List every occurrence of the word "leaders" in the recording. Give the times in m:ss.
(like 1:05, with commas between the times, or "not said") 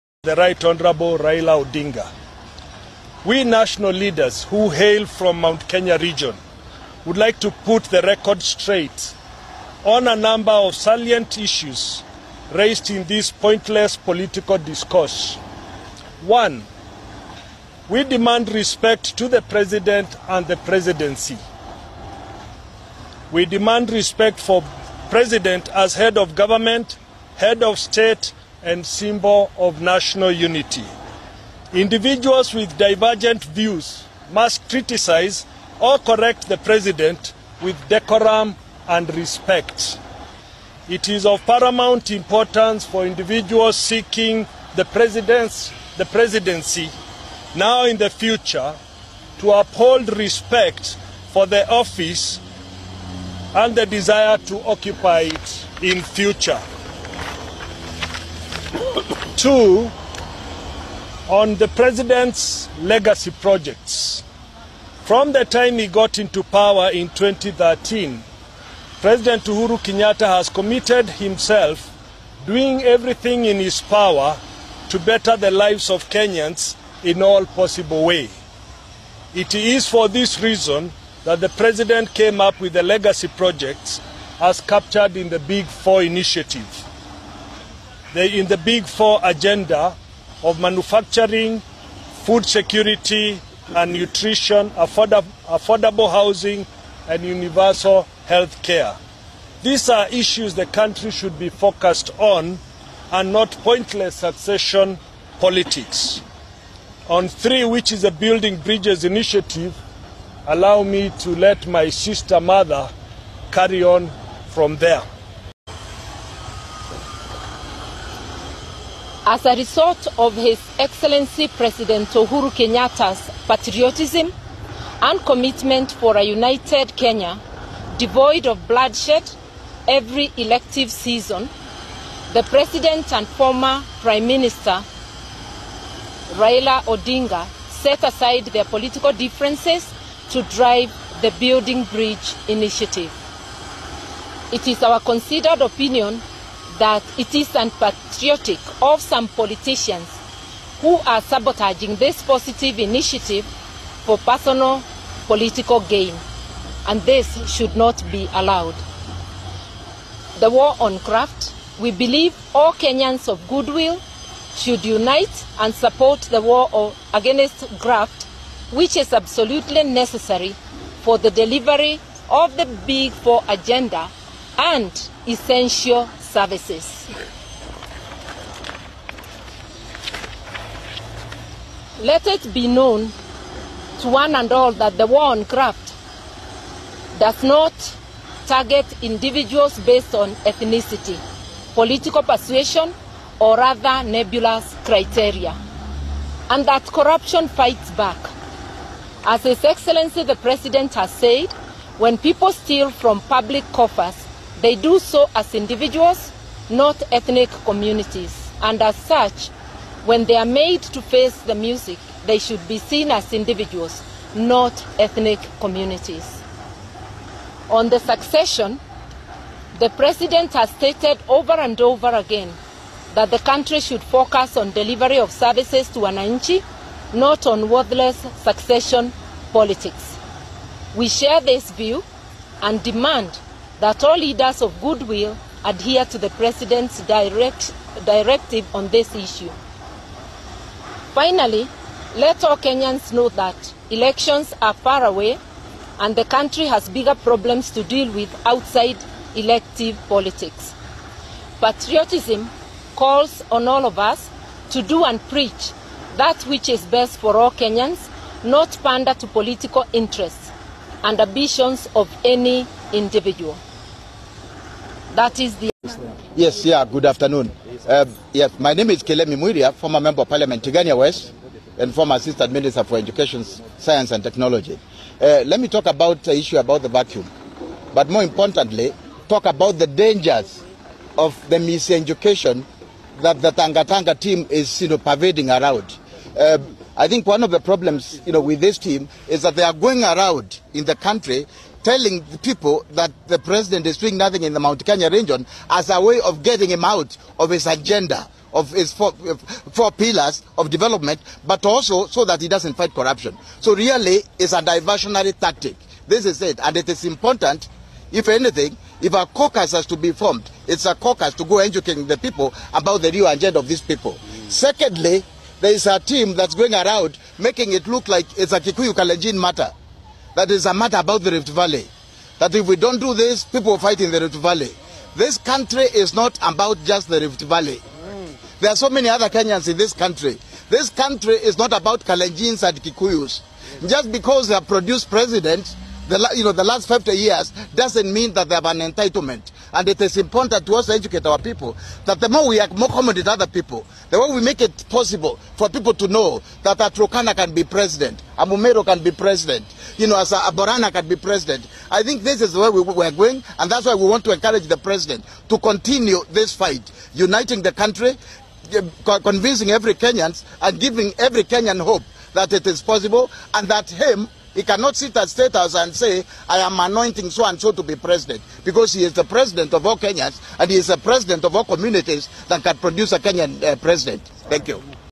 0:03, 3:54.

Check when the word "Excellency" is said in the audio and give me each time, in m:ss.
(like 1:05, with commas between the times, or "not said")
2:00, 3:19.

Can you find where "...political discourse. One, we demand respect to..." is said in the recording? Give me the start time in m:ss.
0:13.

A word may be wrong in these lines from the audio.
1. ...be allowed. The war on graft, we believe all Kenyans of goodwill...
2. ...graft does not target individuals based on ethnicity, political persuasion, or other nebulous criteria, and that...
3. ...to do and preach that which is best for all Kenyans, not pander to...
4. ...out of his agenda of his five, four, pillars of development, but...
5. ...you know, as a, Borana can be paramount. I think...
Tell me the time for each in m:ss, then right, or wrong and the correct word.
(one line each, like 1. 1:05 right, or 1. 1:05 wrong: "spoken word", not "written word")
1. 2:38 right
2. 3:05 right
3. 4:14 right
4. 4:56 wrong: "four", not "five"
5. 5:49 wrong: "president", not "paramount".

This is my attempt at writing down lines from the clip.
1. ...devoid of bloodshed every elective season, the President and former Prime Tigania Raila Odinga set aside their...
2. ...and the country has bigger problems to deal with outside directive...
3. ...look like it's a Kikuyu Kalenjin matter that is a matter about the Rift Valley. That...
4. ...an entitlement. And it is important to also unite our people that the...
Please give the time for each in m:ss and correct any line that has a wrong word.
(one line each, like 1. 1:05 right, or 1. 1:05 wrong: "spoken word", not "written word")
1. 2:07 wrong: "Minister", not "Tigania"
2. 4:05 wrong: "elective", not "directive"
3. 5:17 right
4. 5:38 wrong: "educate", not "unite".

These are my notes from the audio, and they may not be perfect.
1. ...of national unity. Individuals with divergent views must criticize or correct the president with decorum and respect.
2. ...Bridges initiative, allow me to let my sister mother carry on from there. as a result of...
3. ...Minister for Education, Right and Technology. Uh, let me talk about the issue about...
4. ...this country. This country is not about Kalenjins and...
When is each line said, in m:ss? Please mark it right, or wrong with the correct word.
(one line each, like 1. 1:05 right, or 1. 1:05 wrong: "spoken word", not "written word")
1. 0:29 right
2. 1:48 right
3. 4:32 wrong: "Science", not "Right"
4. 5:29 right.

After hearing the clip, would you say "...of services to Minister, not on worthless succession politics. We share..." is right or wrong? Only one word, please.
wrong.